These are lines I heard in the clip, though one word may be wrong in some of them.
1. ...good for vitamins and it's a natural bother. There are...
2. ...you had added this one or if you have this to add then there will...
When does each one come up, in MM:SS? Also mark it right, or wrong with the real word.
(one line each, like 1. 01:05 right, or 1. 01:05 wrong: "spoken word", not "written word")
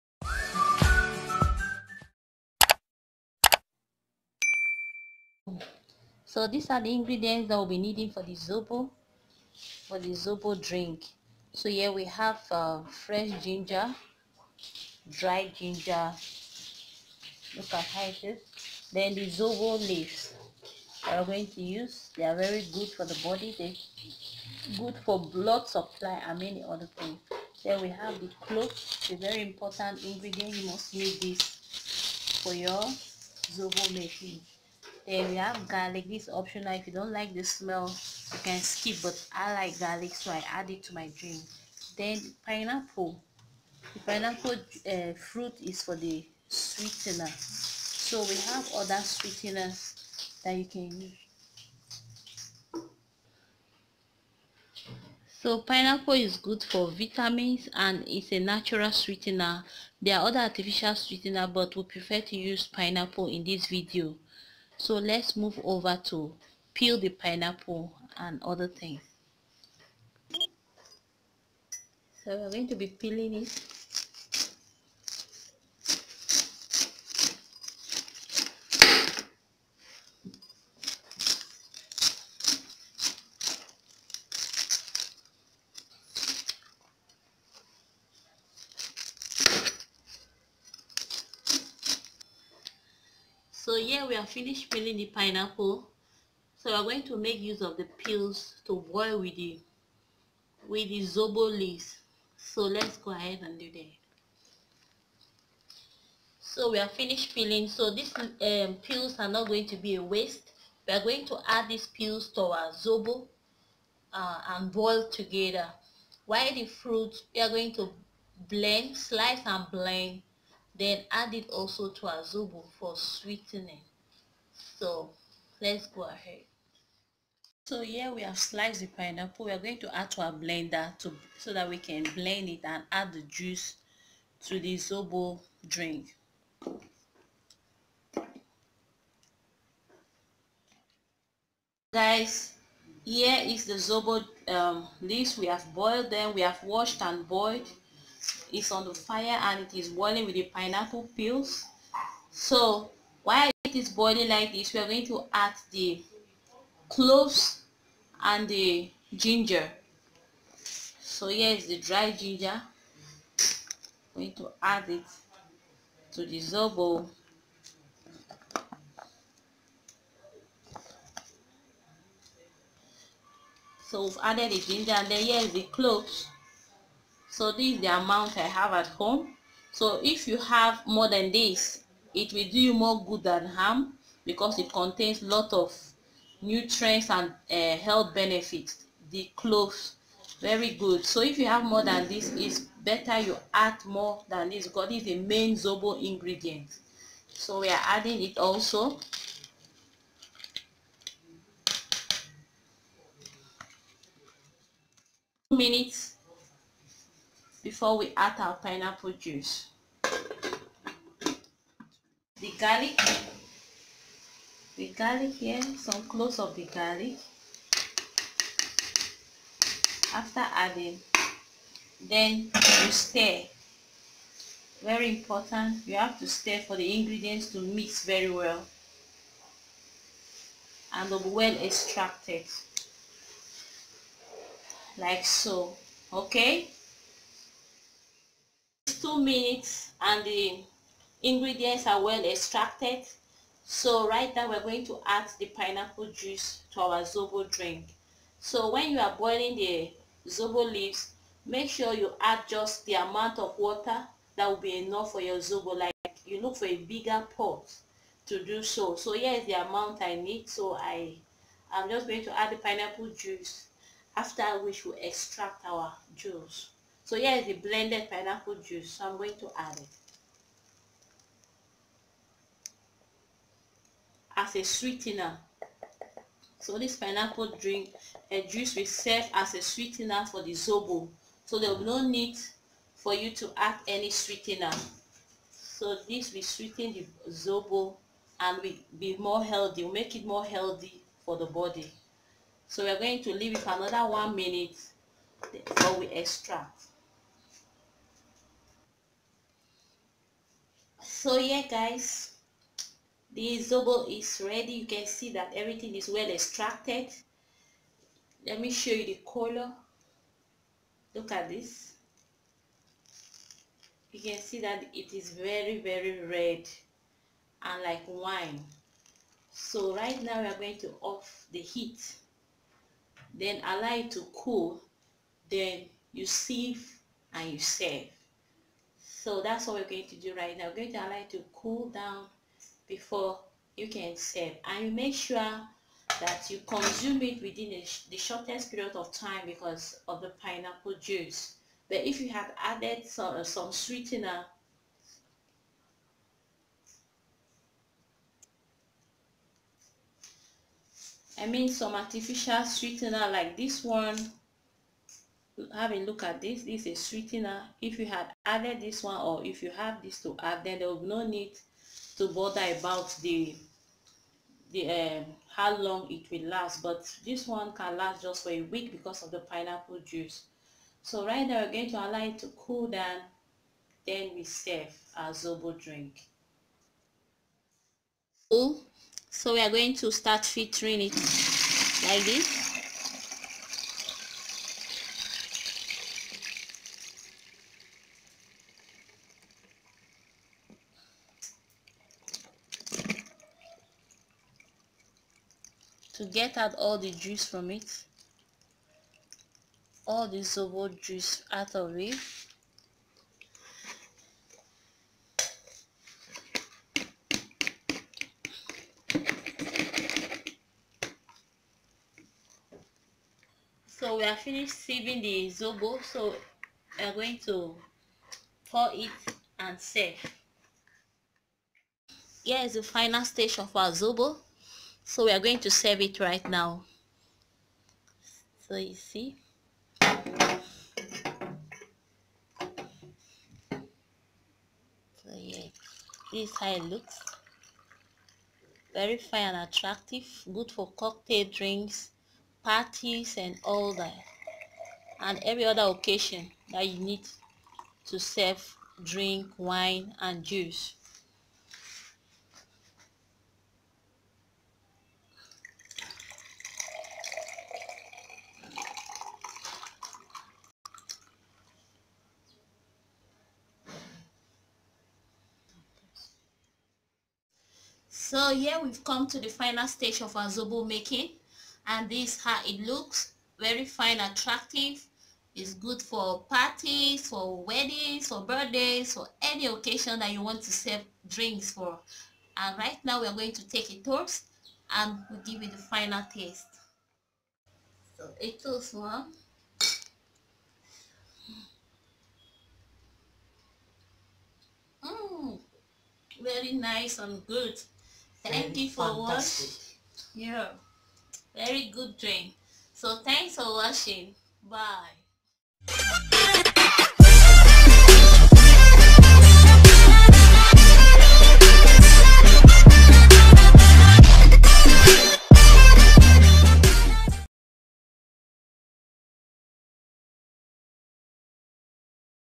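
1. 00:56 wrong: "sweetener", not "bother"
2. 05:57 right.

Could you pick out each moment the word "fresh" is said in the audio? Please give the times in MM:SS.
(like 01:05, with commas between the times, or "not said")
00:13.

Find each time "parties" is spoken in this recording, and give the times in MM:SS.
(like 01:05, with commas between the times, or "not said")
07:22, 07:56.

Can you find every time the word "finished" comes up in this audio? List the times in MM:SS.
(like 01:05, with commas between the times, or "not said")
01:34, 01:46, 06:54.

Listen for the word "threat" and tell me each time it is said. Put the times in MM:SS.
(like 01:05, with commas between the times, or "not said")
not said.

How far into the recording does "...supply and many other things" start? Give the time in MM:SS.
00:25.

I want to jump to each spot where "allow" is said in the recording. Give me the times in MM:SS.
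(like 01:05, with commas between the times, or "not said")
05:23, 05:30, 06:11.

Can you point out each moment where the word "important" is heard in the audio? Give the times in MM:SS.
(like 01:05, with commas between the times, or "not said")
00:29, 03:45.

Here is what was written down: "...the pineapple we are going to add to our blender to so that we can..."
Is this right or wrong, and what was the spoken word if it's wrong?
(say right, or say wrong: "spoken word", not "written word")
right.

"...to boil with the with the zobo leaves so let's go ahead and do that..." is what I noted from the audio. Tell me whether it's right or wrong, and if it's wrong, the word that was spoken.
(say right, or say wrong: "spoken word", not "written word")
right.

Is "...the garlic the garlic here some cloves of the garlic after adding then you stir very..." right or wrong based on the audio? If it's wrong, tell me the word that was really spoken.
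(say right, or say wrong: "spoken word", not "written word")
right.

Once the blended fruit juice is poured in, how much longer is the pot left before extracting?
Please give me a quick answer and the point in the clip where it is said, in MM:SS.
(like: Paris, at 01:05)
1 minute, at 04:54.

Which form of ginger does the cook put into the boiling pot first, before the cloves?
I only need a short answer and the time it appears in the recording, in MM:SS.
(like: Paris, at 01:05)
dry ginger, at 02:41.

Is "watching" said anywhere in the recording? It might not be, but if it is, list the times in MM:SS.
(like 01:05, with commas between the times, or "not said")
08:19, 08:23.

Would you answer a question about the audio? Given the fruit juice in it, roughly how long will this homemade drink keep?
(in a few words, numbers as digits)
a week.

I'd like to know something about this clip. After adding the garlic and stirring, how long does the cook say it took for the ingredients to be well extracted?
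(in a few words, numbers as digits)
2 minutes.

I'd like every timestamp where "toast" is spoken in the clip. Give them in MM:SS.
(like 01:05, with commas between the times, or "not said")
08:03, 08:08.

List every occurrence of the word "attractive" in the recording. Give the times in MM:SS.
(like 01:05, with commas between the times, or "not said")
07:19, 07:54.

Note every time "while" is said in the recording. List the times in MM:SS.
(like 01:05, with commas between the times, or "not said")
01:56, 02:33.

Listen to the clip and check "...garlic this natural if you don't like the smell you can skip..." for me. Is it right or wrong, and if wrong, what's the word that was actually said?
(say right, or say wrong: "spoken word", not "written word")
wrong: "optional", not "natural".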